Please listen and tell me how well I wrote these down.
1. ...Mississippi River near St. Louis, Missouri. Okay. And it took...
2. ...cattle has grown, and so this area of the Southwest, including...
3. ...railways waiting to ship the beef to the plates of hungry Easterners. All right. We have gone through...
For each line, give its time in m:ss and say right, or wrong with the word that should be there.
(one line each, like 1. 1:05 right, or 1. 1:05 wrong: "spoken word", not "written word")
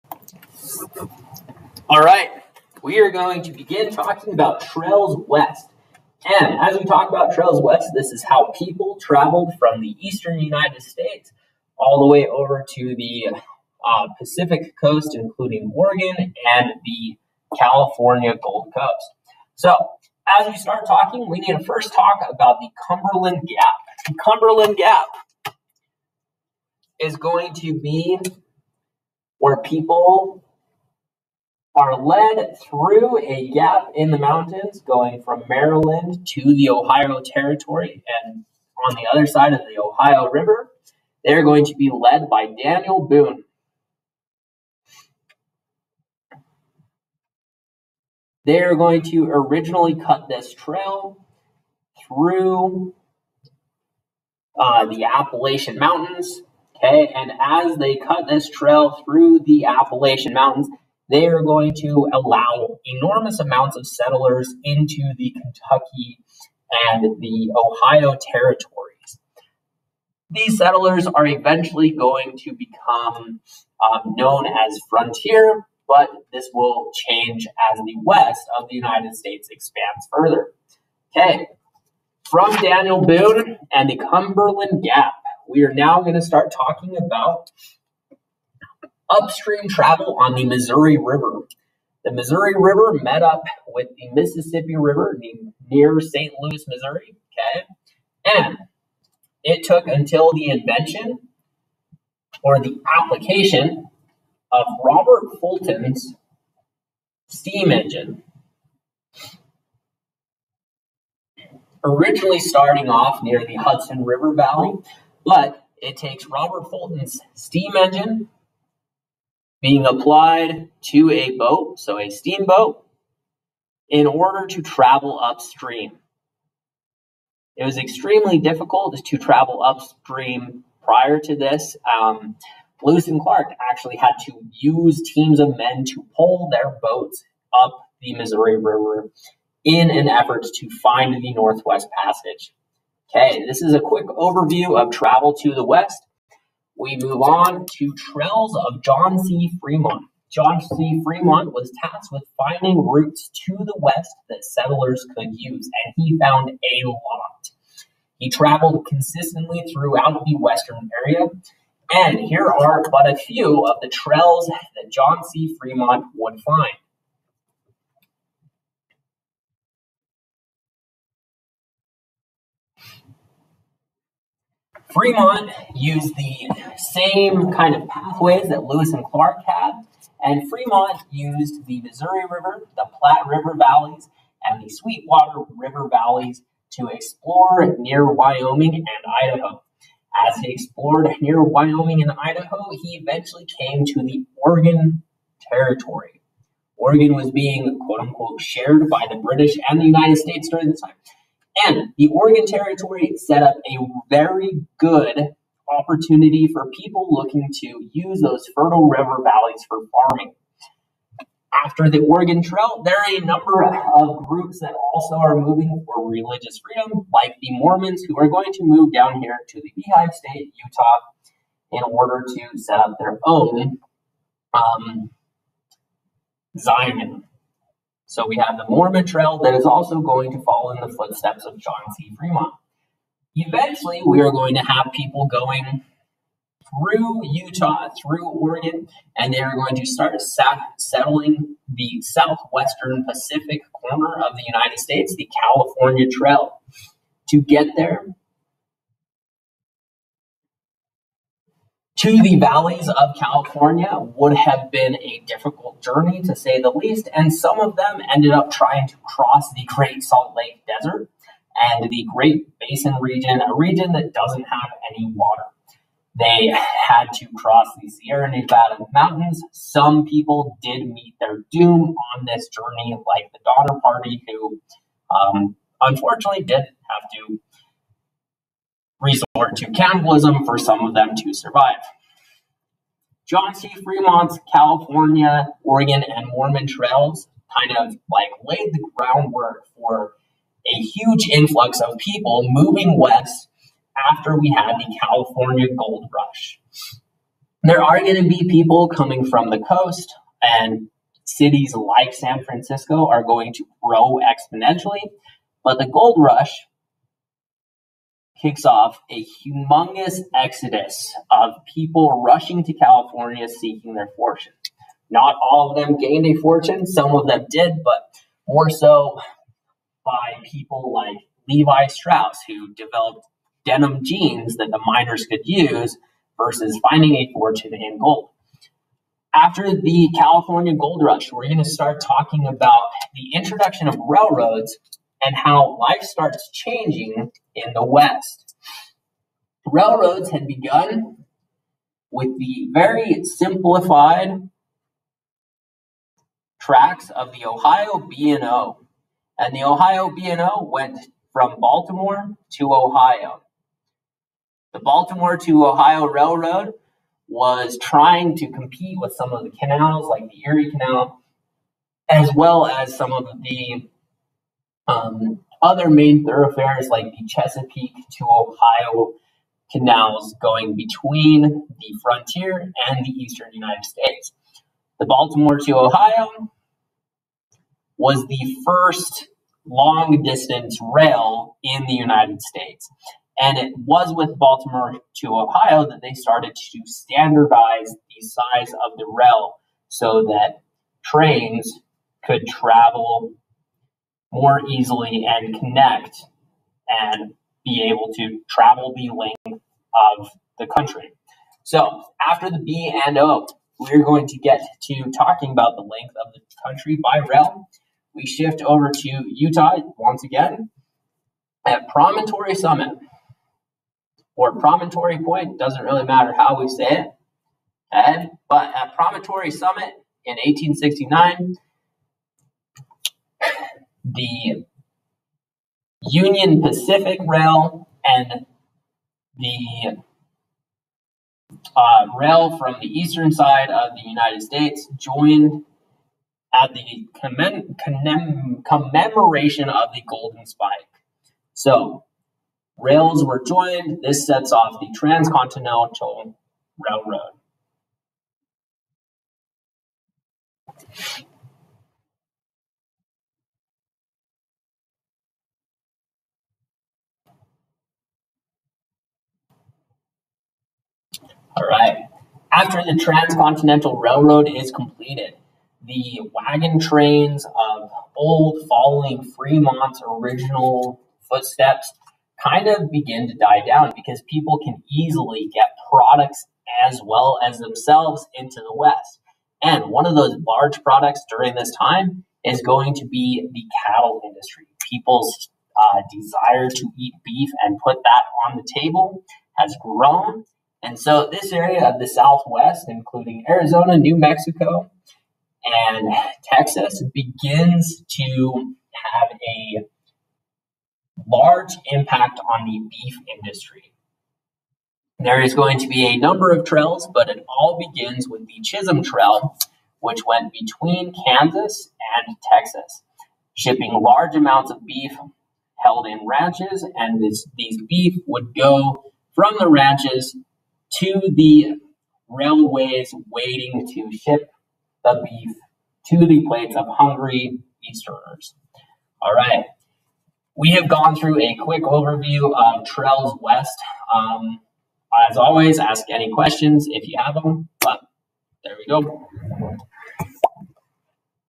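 1. 1:34 right
2. 8:08 wrong: "table", not "cattle"
3. 8:42 right.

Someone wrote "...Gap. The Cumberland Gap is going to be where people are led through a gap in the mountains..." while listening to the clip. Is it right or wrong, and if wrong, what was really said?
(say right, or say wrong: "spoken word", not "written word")
right.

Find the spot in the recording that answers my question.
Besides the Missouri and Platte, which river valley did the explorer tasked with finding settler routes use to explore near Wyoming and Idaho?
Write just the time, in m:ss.
3:04.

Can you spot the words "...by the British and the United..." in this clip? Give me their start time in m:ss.
3:18.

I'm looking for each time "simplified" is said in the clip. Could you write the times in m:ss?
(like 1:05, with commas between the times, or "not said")
5:43.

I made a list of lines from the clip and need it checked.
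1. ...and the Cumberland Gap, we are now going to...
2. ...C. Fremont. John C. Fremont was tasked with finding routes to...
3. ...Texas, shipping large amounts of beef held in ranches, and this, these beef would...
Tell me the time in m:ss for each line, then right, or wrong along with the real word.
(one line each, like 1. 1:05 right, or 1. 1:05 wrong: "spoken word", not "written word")
1. 1:23 right
2. 2:29 right
3. 8:32 right.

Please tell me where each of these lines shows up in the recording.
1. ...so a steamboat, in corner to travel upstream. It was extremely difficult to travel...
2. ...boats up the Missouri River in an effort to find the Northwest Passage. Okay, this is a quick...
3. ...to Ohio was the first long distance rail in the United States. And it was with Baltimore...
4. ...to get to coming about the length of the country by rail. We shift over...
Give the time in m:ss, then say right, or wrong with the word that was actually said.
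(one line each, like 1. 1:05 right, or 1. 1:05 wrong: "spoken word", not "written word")
1. 2:01 wrong: "order", not "corner"
2. 2:16 right
3. 6:15 right
4. 6:44 wrong: "talking", not "coming".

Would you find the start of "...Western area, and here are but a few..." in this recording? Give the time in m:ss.
2:40.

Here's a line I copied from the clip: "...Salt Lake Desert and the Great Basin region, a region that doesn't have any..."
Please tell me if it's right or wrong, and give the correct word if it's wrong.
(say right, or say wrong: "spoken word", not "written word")
right.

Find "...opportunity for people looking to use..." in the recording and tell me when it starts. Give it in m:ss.
3:25.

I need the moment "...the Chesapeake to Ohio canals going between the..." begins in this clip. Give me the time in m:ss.
6:07.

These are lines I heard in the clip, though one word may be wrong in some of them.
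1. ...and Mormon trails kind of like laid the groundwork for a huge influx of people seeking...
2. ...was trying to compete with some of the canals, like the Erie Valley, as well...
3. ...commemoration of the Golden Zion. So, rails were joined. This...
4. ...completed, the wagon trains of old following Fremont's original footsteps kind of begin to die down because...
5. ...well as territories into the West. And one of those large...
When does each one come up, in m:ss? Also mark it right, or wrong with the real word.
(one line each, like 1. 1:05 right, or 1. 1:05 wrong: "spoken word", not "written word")
1. 4:46 wrong: "moving", not "seeking"
2. 5:57 wrong: "Canal", not "Valley"
3. 7:18 wrong: "Spike", not "Zion"
4. 7:44 right
5. 7:57 wrong: "themselves", not "territories".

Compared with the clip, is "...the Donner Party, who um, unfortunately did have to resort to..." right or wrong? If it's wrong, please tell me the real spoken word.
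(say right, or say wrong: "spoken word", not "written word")
right.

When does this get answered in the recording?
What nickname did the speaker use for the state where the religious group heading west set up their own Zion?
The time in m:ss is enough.
3:39.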